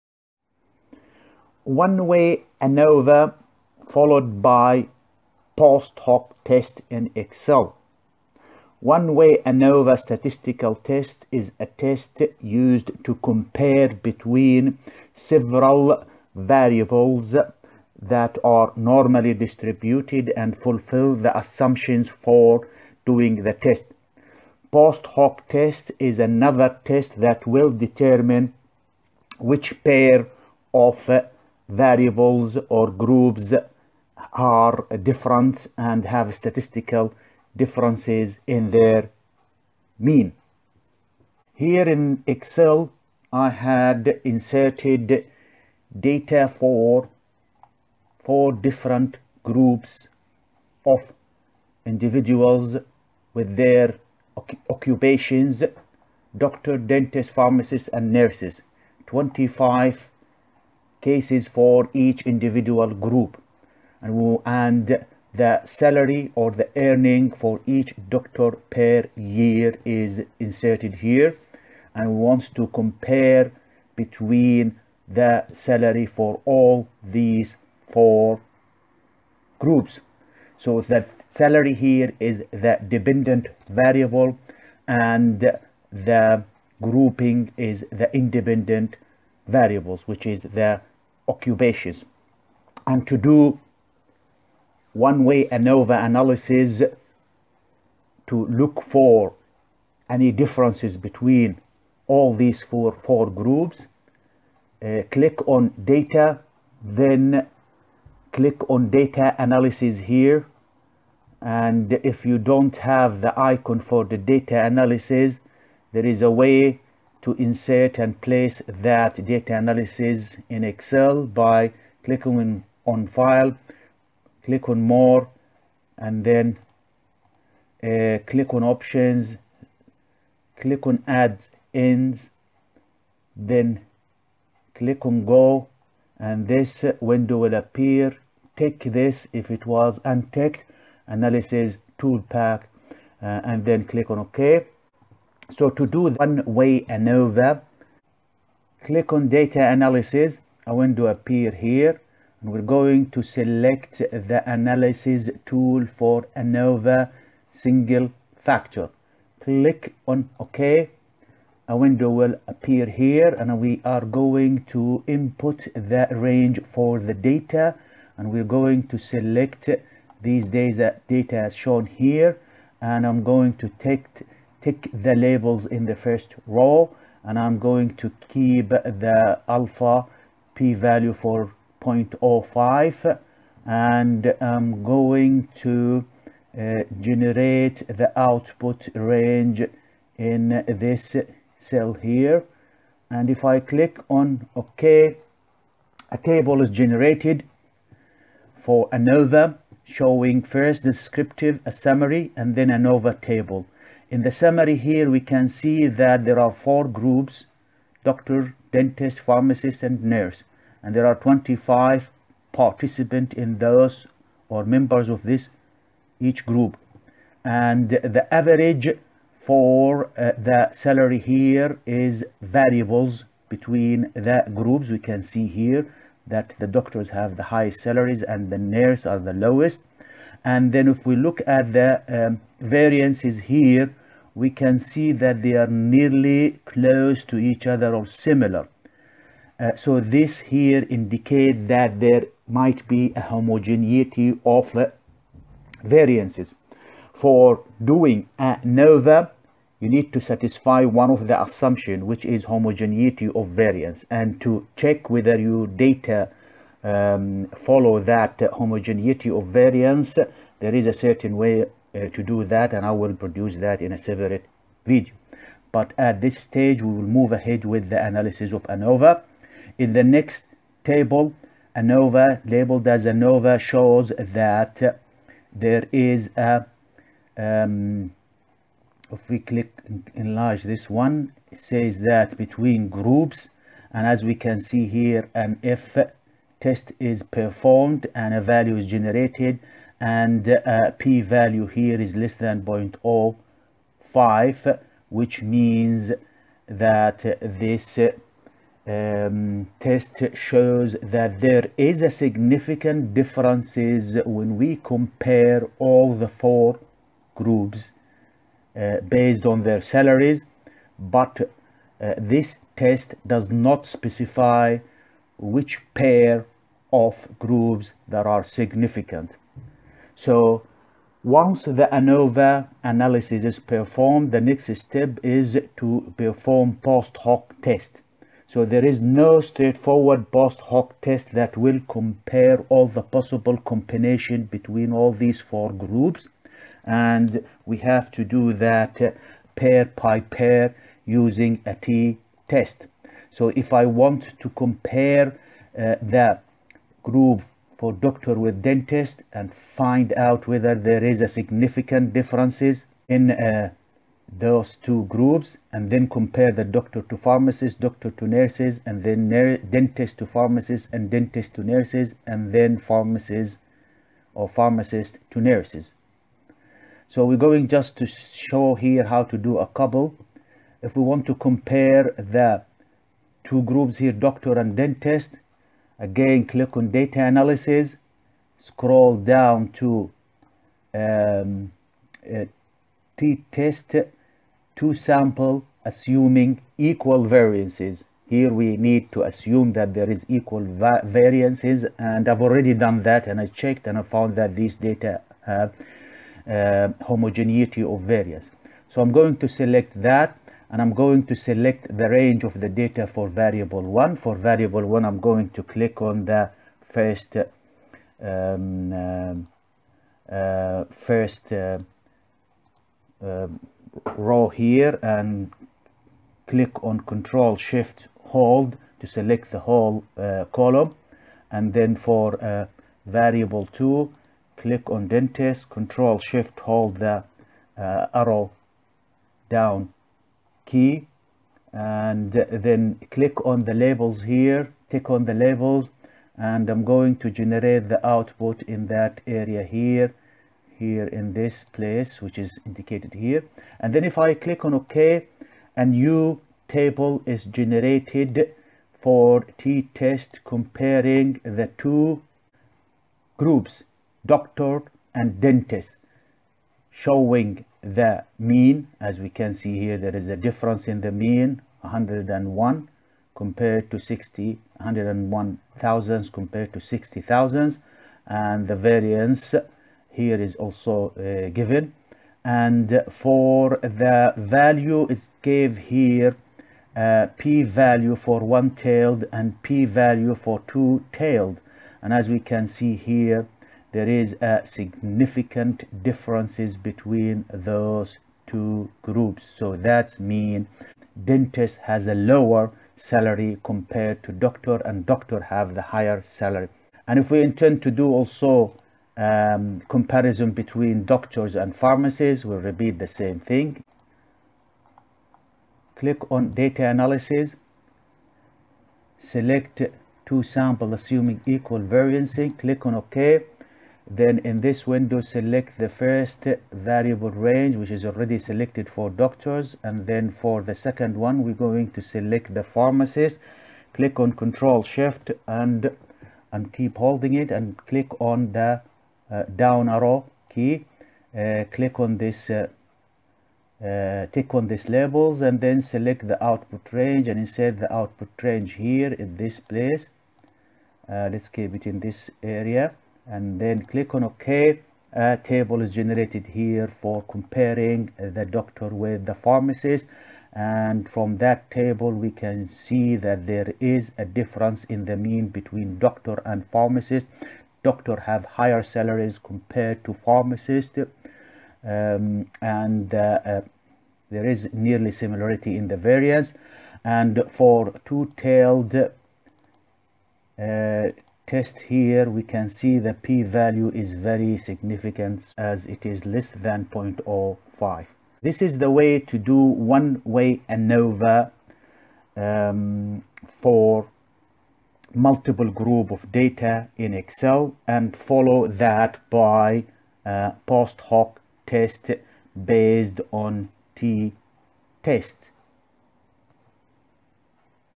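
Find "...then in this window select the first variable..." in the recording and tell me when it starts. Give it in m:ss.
8:34.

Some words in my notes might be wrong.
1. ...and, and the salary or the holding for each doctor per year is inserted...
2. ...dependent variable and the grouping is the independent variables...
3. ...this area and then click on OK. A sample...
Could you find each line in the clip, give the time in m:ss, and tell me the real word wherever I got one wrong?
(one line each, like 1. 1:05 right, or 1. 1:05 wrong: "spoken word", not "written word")
1. 1:04 wrong: "earning", not "holding"
2. 1:22 right
3. 9:01 wrong: "table", not "sample".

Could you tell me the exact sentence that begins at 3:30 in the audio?
And there are 25 participants in those or members of this each group.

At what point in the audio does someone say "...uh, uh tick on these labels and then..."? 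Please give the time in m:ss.
8:52.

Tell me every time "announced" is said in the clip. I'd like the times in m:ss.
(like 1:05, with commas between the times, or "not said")
not said.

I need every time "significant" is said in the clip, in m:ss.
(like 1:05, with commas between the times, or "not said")
5:02, 5:18, 5:51, 8:04, 9:34.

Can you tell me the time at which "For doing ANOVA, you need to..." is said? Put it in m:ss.
4:07.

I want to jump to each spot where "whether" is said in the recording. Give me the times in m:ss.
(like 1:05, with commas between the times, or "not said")
4:15, 5:50.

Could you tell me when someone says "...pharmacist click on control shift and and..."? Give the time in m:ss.
8:42.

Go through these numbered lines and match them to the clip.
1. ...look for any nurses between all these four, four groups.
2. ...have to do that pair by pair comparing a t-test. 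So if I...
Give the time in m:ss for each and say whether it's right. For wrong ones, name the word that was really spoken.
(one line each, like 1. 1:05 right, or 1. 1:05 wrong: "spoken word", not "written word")
1. 1:38 wrong: "differences", not "nurses"
2. 5:37 wrong: "using", not "comparing".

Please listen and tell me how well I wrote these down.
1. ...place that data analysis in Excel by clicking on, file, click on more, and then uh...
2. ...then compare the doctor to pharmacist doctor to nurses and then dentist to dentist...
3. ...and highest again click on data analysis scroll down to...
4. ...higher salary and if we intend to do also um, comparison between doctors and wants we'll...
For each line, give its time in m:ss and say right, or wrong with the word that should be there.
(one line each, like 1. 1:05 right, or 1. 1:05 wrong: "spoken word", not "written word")
1. 1:58 right
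2. 5:55 wrong: "pharmacist", not "dentist"
3. 6:14 wrong: "dentist", not "highest"
4. 8:15 wrong: "pharmacists", not "wants".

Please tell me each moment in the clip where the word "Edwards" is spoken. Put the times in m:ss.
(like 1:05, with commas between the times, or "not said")
not said.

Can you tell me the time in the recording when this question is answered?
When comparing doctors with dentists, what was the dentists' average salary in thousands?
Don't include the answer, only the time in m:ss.
7:46.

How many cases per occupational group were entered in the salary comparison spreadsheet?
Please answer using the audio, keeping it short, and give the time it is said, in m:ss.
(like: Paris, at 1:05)
25, at 0:59.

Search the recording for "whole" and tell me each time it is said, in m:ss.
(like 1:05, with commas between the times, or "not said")
6:59.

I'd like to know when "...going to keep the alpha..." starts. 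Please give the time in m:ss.
2:57.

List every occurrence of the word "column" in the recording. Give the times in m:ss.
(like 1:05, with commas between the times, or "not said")
7:00.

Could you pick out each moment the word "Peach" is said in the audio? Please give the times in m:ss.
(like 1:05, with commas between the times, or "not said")
not said.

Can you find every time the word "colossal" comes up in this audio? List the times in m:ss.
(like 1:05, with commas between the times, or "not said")
not said.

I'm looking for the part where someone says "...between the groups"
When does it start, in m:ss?
3:43.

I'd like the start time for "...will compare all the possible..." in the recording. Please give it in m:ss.
5:31.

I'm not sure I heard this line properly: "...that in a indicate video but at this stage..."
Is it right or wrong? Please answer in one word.
wrong.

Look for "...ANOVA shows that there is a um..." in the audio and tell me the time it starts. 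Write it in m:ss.
4:33.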